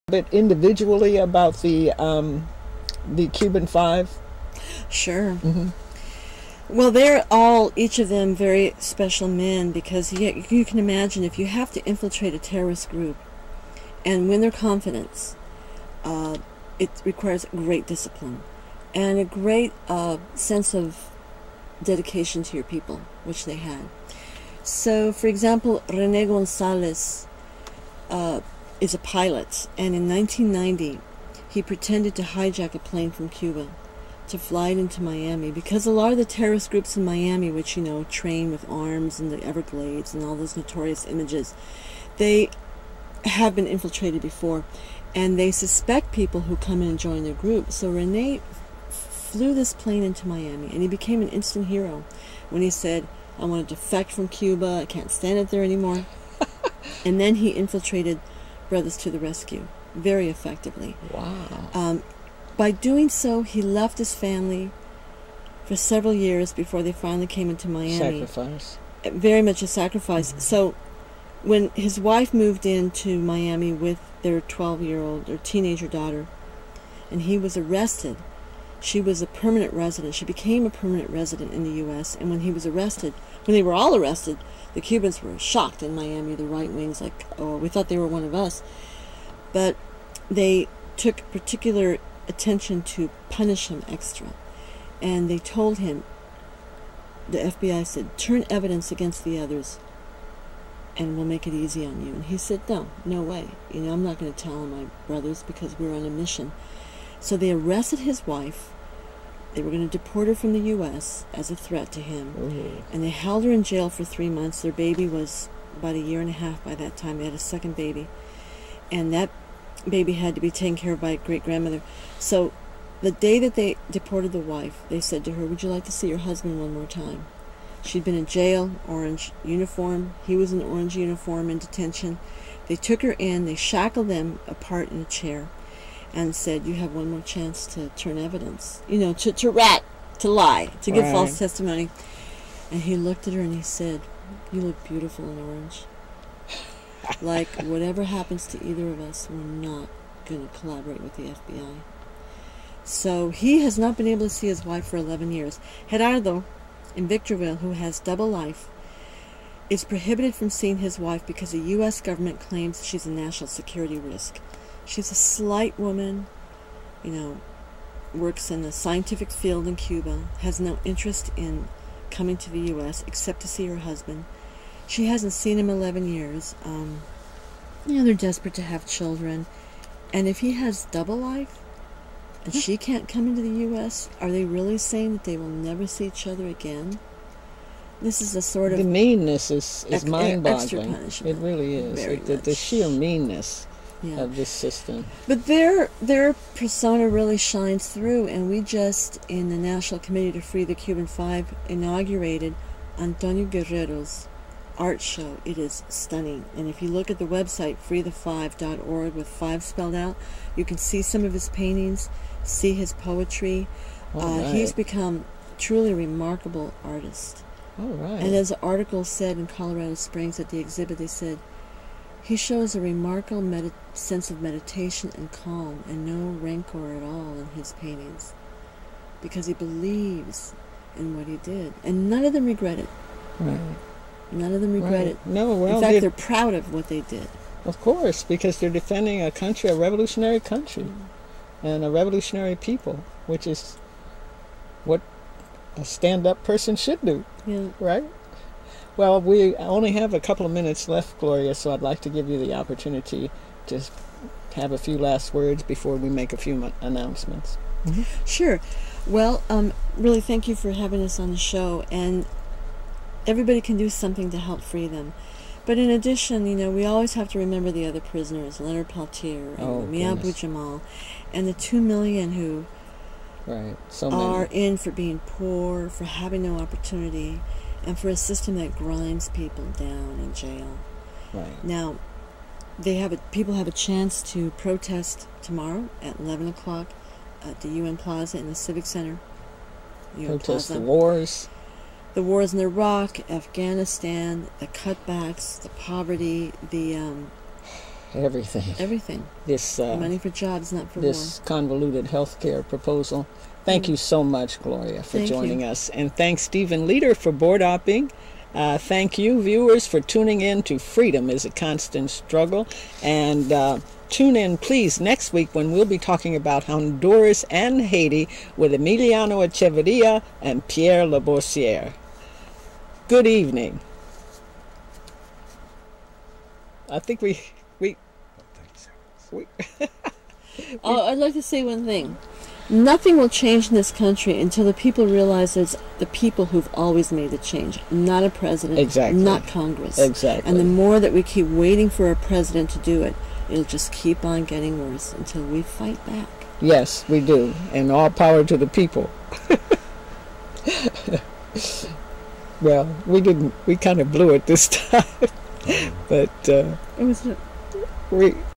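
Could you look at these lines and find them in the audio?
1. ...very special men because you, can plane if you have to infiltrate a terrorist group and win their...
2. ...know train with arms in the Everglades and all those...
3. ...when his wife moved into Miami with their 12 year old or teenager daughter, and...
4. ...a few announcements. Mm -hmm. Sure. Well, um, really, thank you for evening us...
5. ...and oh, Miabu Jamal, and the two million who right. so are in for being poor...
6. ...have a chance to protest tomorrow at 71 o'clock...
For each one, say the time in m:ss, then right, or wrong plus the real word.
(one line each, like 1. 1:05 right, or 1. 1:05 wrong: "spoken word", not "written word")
1. 0:08 wrong: "imagine", not "plane"
2. 0:37 right
3. 1:11 right
4. 4:16 wrong: "having", not "evening"
5. 4:29 right
6. 4:43 wrong: "11", not "71".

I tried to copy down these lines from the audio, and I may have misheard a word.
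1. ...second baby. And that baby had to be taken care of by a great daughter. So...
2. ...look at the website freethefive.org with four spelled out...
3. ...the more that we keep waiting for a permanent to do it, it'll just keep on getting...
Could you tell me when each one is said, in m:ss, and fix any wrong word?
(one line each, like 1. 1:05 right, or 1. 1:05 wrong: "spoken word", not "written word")
1. 1:57 wrong: "grandmother", not "daughter"
2. 3:26 wrong: "five", not "four"
3. 5:40 wrong: "president", not "permanent".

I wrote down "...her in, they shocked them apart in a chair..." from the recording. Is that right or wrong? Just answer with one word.
wrong.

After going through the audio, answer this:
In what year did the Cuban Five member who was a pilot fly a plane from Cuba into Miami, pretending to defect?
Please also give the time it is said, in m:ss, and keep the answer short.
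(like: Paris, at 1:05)
1990, at 0:30.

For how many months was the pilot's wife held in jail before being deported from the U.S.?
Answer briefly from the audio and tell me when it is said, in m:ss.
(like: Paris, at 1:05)
3, at 1:54.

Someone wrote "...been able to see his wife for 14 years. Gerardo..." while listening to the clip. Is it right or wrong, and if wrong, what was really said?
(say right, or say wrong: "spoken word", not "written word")
wrong: "11", not "14".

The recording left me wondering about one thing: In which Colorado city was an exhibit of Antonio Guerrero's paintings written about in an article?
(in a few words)
Colorado Springs.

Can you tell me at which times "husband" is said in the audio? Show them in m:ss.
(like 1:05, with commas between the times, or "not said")
2:06, 2:53.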